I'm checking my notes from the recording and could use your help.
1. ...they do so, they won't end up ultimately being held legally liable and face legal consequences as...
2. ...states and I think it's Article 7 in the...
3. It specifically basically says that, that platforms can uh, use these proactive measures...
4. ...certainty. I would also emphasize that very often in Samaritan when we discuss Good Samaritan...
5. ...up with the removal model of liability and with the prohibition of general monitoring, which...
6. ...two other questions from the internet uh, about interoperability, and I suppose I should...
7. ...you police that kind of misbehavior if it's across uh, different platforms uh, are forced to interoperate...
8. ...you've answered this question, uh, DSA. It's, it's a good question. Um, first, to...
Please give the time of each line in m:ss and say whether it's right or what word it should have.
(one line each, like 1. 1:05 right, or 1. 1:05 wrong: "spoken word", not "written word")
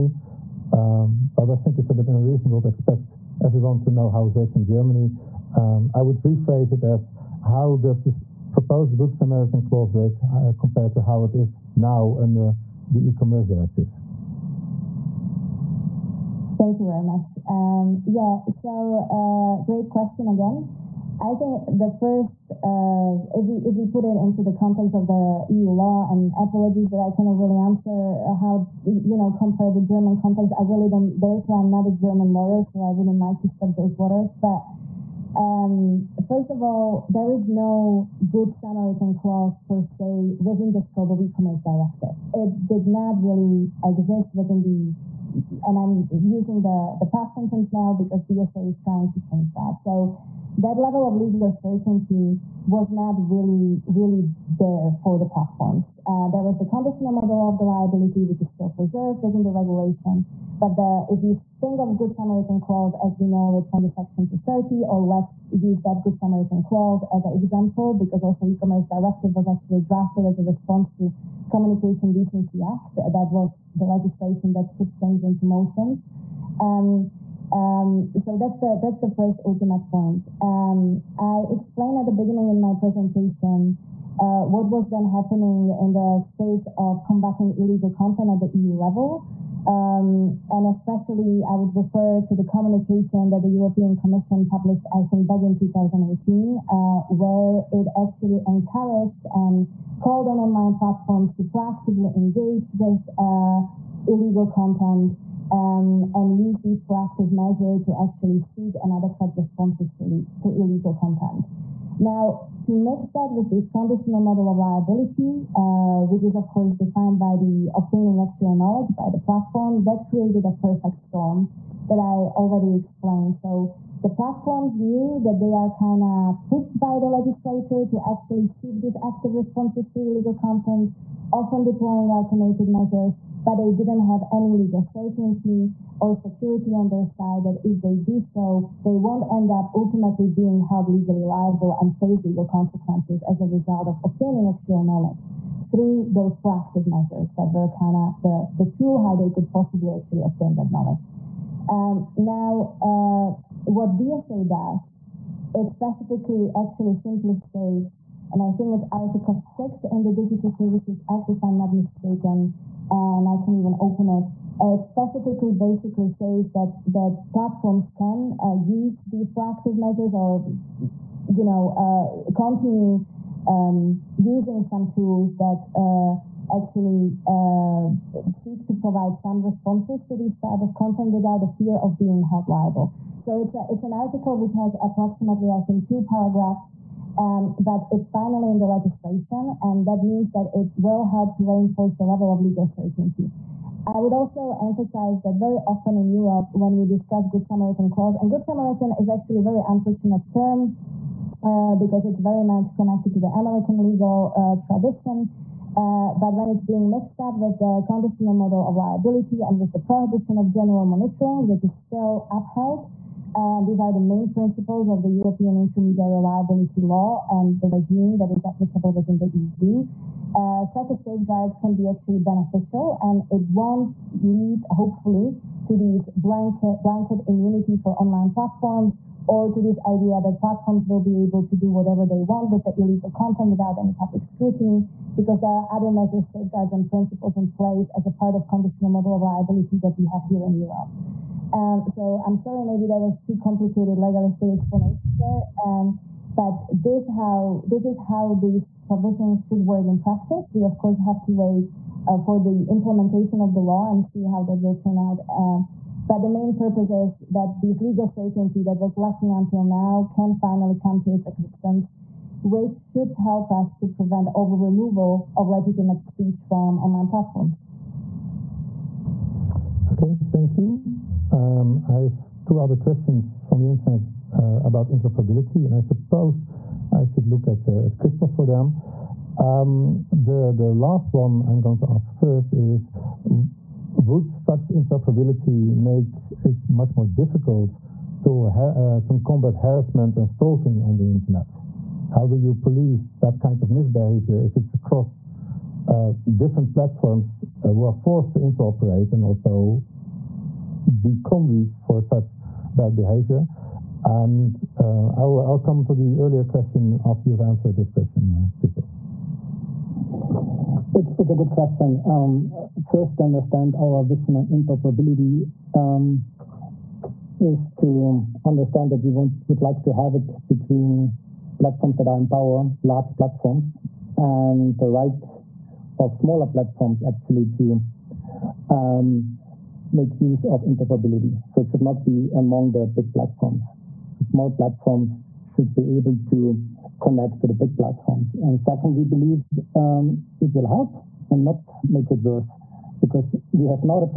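1. 2:17 right
2. 2:37 wrong: "6", not "7"
3. 2:44 right
4. 3:12 wrong: "Europe", not "Samaritan"
5. 3:27 wrong: "conditional", not "removal"
6. 4:32 right
7. 4:52 right
8. 5:07 wrong: "Christoph", not "DSA".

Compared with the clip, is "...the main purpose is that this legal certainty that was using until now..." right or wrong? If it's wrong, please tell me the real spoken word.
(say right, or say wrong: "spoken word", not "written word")
wrong: "lacking", not "using".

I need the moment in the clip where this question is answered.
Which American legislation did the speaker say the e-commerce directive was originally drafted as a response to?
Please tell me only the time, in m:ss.
1:11.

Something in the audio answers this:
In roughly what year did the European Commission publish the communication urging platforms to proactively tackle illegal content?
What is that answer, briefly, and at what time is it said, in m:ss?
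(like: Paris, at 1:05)
2018, at 1:35.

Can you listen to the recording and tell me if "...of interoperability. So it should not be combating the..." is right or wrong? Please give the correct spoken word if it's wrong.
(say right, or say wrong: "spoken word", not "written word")
wrong: "among", not "combating".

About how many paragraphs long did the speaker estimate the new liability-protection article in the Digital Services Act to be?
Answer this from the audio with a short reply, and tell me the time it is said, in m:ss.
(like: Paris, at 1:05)
2, at 3:05.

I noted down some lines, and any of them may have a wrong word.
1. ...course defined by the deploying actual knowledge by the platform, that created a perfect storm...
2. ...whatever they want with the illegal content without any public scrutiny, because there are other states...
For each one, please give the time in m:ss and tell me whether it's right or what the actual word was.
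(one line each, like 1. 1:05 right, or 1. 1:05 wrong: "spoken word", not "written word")
1. 1:56 wrong: "obtaining", not "deploying"
2. 3:51 wrong: "measures", not "states".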